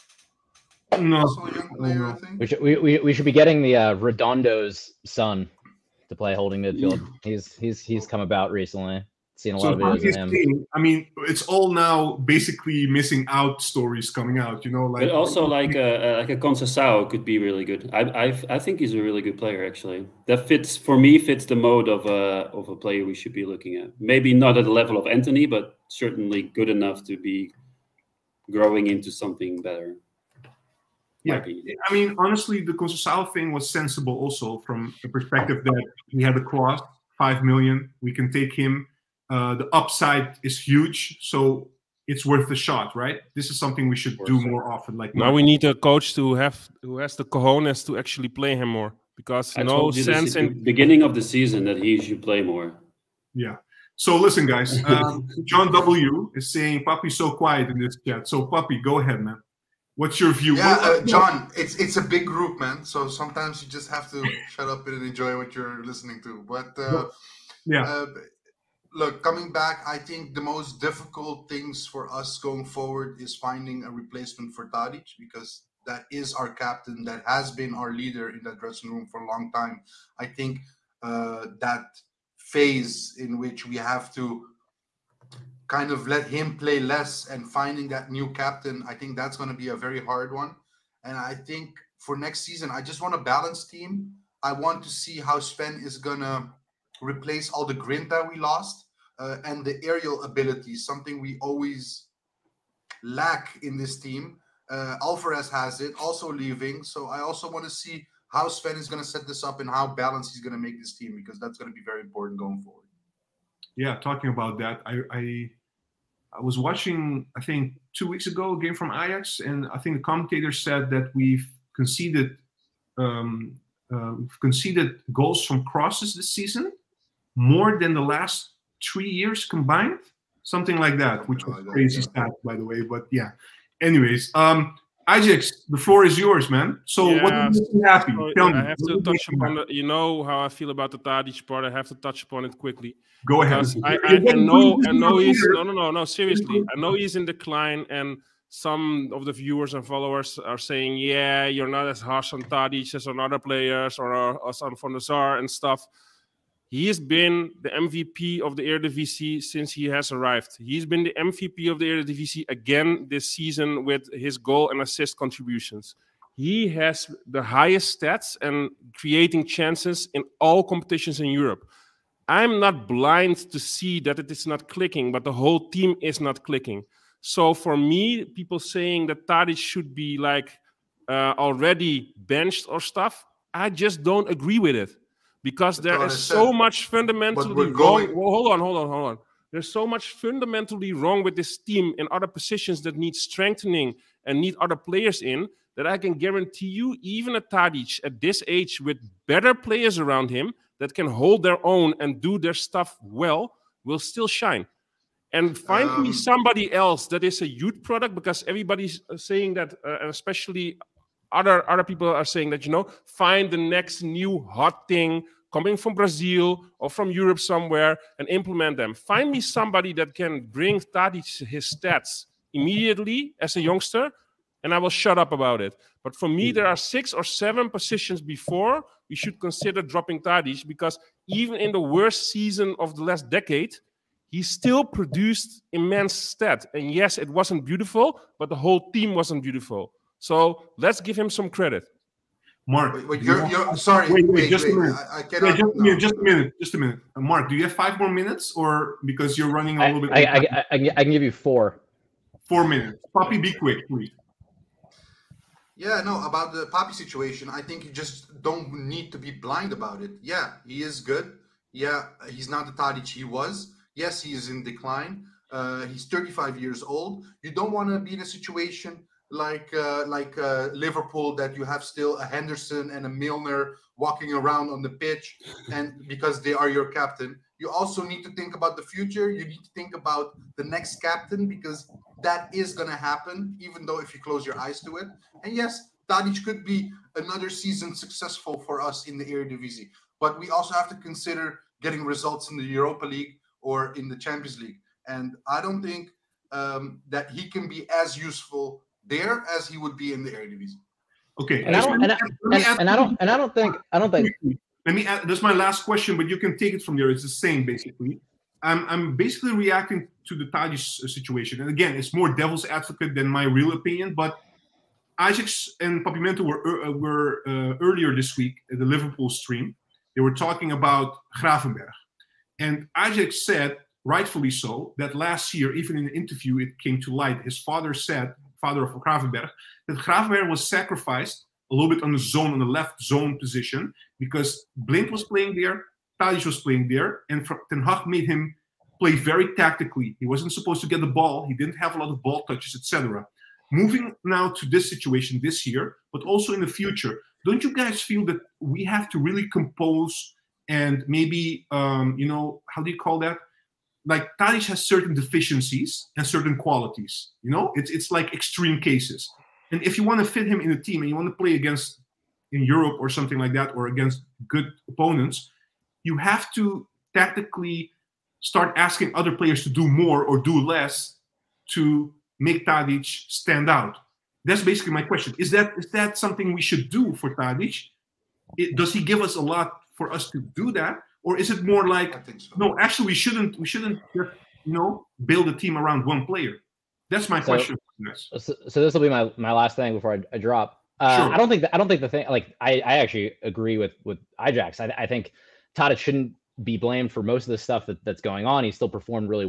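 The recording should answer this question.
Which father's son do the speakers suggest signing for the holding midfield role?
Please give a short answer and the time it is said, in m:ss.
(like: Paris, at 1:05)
Redondo, at 0:03.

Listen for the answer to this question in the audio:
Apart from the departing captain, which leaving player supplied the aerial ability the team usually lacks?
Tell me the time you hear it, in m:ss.
1:45.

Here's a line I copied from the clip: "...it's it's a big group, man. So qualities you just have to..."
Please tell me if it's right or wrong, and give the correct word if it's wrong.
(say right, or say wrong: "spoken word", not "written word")
wrong: "sometimes", not "qualities".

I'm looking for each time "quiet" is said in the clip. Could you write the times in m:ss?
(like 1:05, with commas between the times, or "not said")
0:57.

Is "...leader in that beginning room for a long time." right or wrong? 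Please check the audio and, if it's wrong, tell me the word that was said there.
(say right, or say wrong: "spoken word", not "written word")
wrong: "dressing", not "beginning".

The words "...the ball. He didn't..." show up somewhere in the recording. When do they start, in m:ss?
5:41.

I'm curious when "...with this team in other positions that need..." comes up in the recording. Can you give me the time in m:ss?
3:11.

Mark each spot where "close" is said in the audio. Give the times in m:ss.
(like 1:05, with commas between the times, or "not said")
4:44.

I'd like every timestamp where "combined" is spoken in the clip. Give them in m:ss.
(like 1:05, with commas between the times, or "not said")
2:09.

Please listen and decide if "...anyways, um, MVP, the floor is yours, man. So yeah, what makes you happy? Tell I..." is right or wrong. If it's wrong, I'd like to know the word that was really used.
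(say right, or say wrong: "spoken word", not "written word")
wrong: "EyeJax", not "MVP".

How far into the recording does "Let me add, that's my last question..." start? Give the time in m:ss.
5:04.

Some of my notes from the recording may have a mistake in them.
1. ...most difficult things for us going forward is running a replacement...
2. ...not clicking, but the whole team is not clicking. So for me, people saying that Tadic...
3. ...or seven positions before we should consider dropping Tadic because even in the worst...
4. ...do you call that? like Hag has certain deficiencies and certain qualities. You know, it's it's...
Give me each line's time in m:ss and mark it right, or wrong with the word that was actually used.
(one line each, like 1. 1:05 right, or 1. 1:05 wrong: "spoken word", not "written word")
1. 1:10 wrong: "finding", not "running"
2. 2:54 right
3. 3:47 right
4. 5:52 wrong: "Tadić", not "Hag".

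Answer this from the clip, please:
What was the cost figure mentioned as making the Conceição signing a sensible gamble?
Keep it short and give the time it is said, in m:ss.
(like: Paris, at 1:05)
5 million, at 0:37.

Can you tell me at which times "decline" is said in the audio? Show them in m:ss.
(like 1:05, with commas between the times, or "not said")
2:27, 4:24.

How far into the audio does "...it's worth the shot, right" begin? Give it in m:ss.
0:42.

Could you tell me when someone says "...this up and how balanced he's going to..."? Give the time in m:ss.
1:49.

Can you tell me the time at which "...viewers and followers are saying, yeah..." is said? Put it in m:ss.
2:29.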